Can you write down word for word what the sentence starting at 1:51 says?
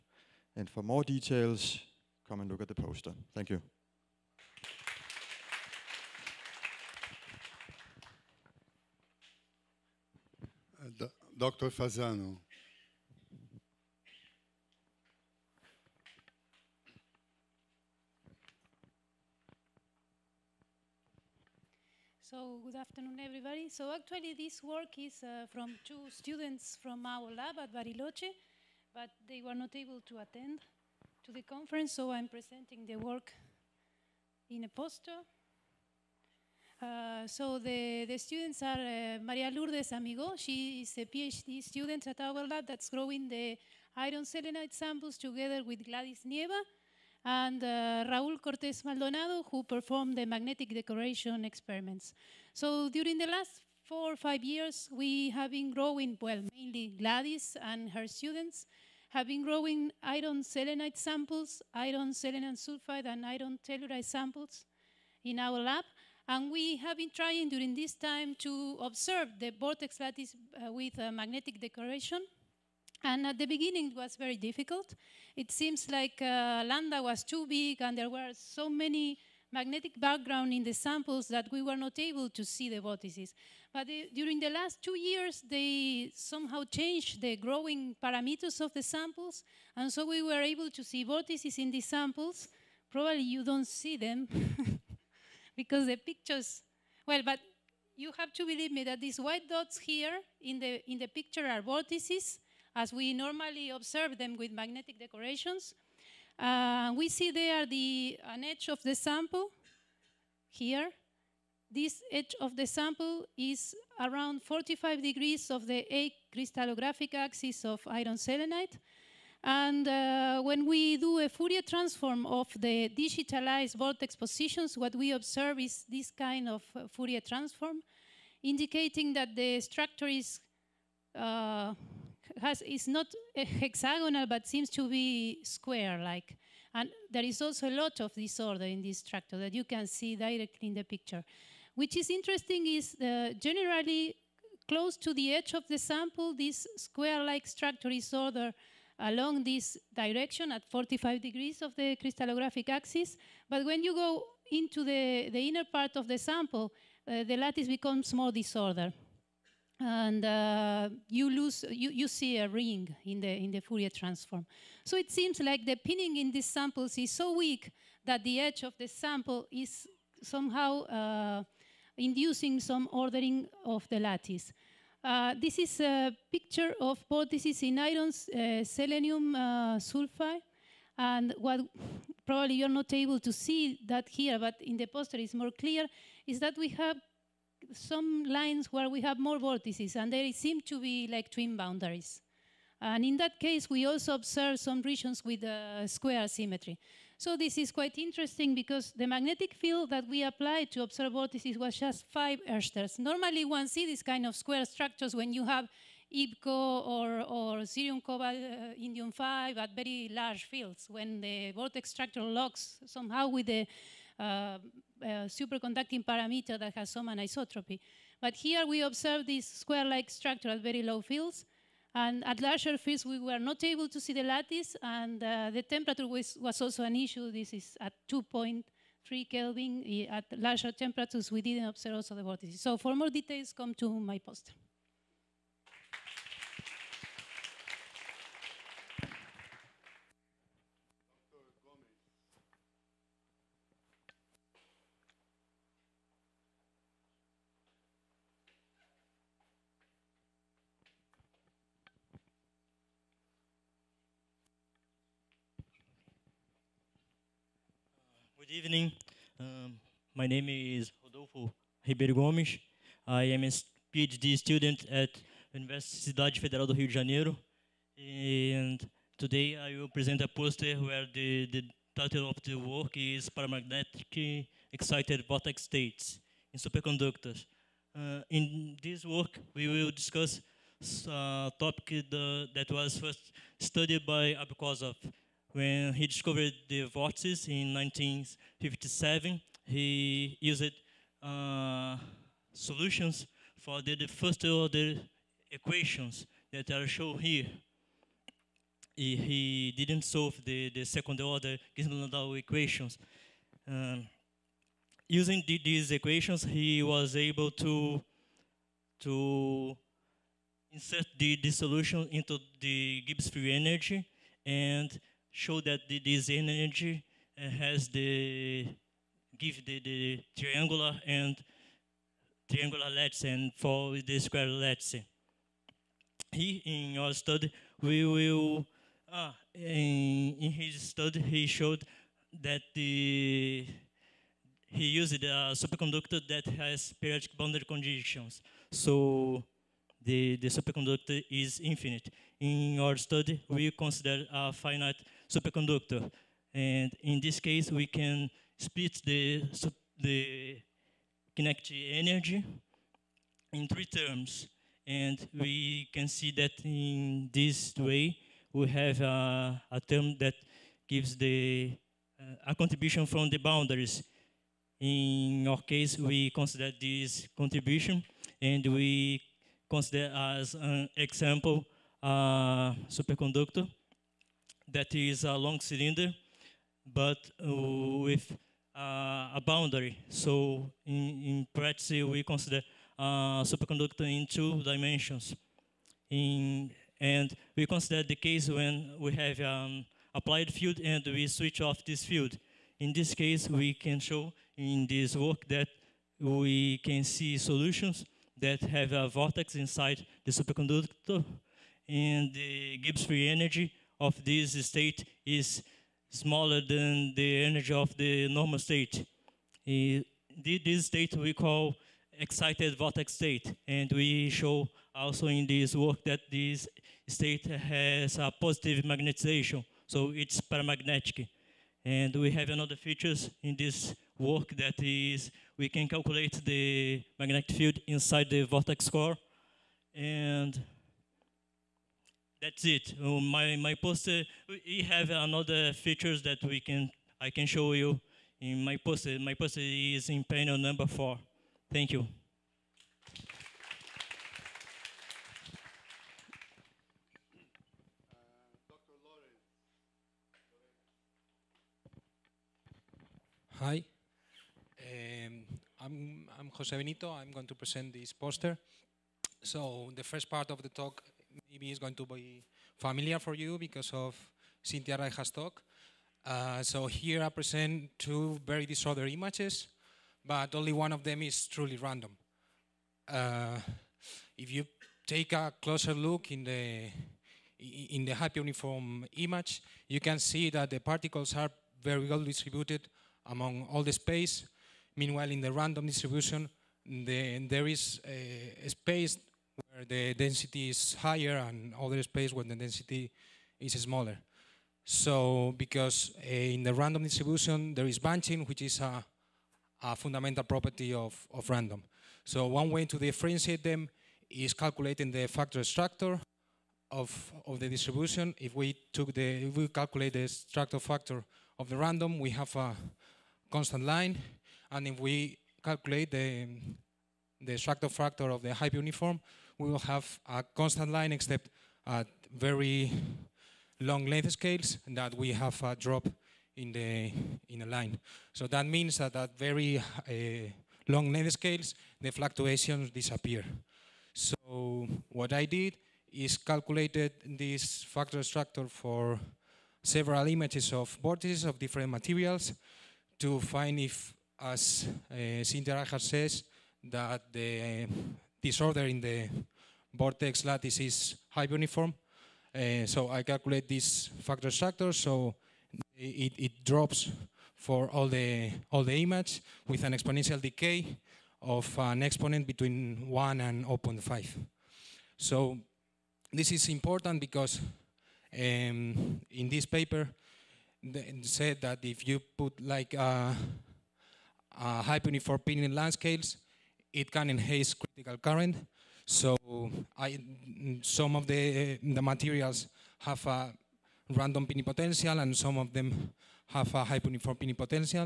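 This edge of the sample is around 45 degrees of the A crystallographic axis of iron selenide.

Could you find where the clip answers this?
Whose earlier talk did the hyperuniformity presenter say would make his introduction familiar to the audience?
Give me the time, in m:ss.
7:44.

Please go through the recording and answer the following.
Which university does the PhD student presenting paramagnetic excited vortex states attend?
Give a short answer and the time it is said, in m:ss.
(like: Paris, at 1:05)
Universidade Federal do Rio de Janeiro, at 4:25.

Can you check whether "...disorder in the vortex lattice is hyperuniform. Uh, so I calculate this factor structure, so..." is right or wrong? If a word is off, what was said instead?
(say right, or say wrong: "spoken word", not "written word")
right.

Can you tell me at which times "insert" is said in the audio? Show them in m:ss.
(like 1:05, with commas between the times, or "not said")
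5:10.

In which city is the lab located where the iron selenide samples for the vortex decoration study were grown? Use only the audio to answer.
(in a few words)
Bariloche.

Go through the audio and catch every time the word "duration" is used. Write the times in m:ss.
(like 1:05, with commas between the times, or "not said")
not said.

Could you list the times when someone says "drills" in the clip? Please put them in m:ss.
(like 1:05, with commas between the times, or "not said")
not said.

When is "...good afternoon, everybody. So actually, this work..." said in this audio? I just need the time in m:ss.
0:22.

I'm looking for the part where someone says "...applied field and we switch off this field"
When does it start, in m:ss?
6:30.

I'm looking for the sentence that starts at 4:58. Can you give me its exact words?
He, he didn't solve the, the second order Ginzburg-Landau equations.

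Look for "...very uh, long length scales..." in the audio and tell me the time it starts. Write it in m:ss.
8:49.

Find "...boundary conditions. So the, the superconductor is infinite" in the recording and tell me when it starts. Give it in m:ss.
5:37.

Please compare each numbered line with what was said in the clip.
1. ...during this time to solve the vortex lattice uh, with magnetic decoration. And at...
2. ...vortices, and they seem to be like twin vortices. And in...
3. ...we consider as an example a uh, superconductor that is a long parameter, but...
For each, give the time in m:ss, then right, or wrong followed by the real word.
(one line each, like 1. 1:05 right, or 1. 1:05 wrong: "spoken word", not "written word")
1. 1:07 wrong: "observe", not "solve"
2. 3:09 wrong: "boundaries", not "vortices"
3. 6:08 wrong: "cylinder", not "parameter".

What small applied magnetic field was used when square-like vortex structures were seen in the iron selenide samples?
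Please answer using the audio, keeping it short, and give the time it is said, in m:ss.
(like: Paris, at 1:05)
5 oersteds, at 3:22.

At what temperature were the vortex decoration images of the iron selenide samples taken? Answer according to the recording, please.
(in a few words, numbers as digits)
2.3 Kelvin.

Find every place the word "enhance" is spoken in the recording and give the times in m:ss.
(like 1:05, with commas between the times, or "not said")
9:37.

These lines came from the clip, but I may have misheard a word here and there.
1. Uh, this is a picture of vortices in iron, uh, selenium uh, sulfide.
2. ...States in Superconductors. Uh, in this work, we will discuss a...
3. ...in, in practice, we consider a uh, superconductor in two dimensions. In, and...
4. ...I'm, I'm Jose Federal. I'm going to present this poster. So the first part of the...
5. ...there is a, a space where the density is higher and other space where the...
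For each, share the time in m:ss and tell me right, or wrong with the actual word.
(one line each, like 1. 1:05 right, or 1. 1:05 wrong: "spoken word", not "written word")
1. 2:55 right
2. 4:35 right
3. 6:20 right
4. 7:35 wrong: "Benito", not "Federal"
5. 8:07 right.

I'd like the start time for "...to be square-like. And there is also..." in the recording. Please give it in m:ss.
2:14.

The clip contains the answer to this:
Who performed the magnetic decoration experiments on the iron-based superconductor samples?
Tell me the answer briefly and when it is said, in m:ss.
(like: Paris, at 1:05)
Raul Cortez Maldonado, at 0:48.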